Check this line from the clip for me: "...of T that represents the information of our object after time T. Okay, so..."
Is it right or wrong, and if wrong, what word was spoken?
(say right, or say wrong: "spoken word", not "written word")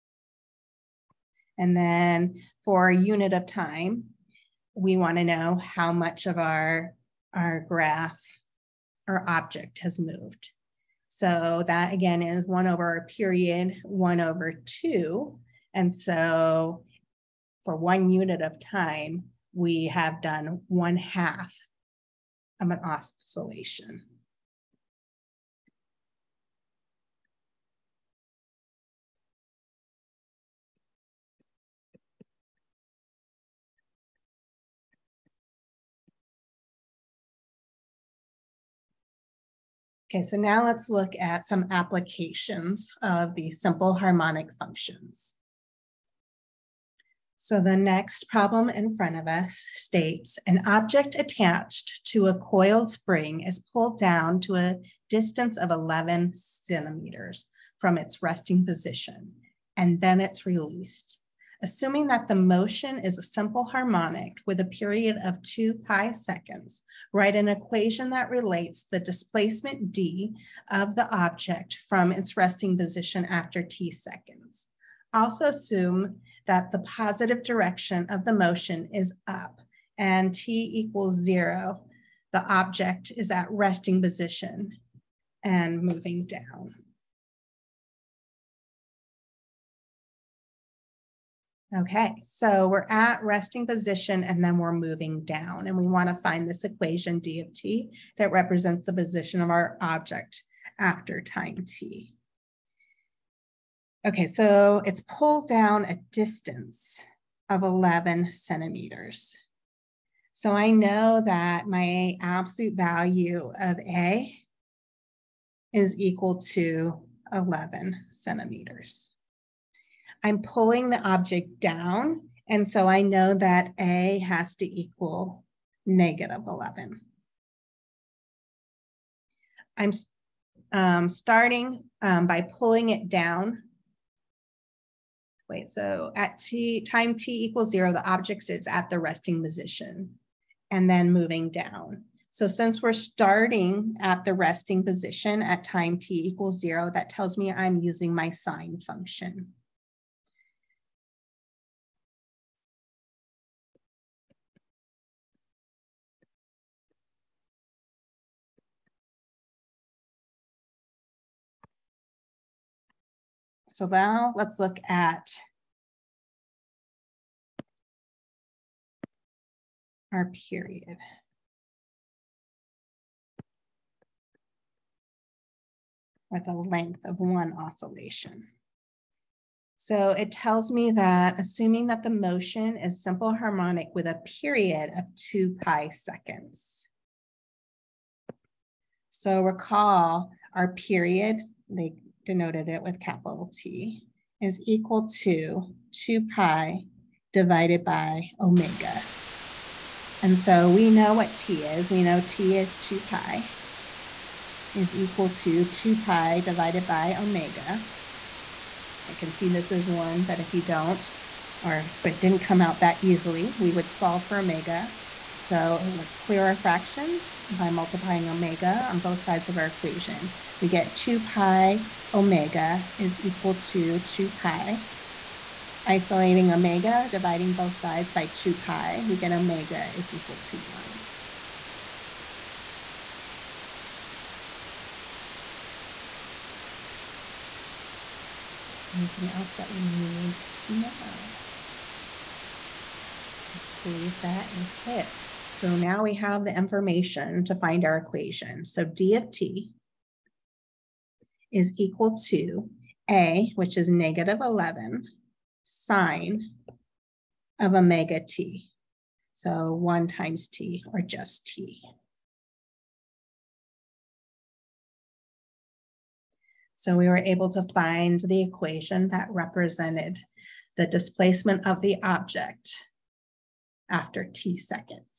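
wrong: "position", not "information".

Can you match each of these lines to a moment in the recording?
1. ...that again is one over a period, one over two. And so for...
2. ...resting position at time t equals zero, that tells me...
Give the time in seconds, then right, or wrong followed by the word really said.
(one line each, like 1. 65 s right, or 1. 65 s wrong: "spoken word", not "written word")
1. 11 s right
2. 144 s right.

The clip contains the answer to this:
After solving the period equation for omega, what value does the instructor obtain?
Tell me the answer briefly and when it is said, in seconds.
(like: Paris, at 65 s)
1, at 229 s.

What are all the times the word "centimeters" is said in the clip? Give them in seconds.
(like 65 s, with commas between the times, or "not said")
56 s, 108 s, 118 s.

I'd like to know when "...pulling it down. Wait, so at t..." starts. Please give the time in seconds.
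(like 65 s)
132 s.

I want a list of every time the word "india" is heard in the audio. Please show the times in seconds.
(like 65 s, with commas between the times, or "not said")
not said.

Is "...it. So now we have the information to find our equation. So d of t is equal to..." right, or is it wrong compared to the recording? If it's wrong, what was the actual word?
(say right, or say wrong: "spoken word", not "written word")
right.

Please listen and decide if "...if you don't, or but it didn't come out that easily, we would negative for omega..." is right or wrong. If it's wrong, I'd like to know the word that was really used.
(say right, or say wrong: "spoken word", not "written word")
wrong: "solve", not "negative".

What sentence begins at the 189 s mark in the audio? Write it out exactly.
So recall our period, like denoted it with capital T, is equal to 2 pi divided by omega.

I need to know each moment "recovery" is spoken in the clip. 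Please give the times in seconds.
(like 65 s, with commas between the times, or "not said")
not said.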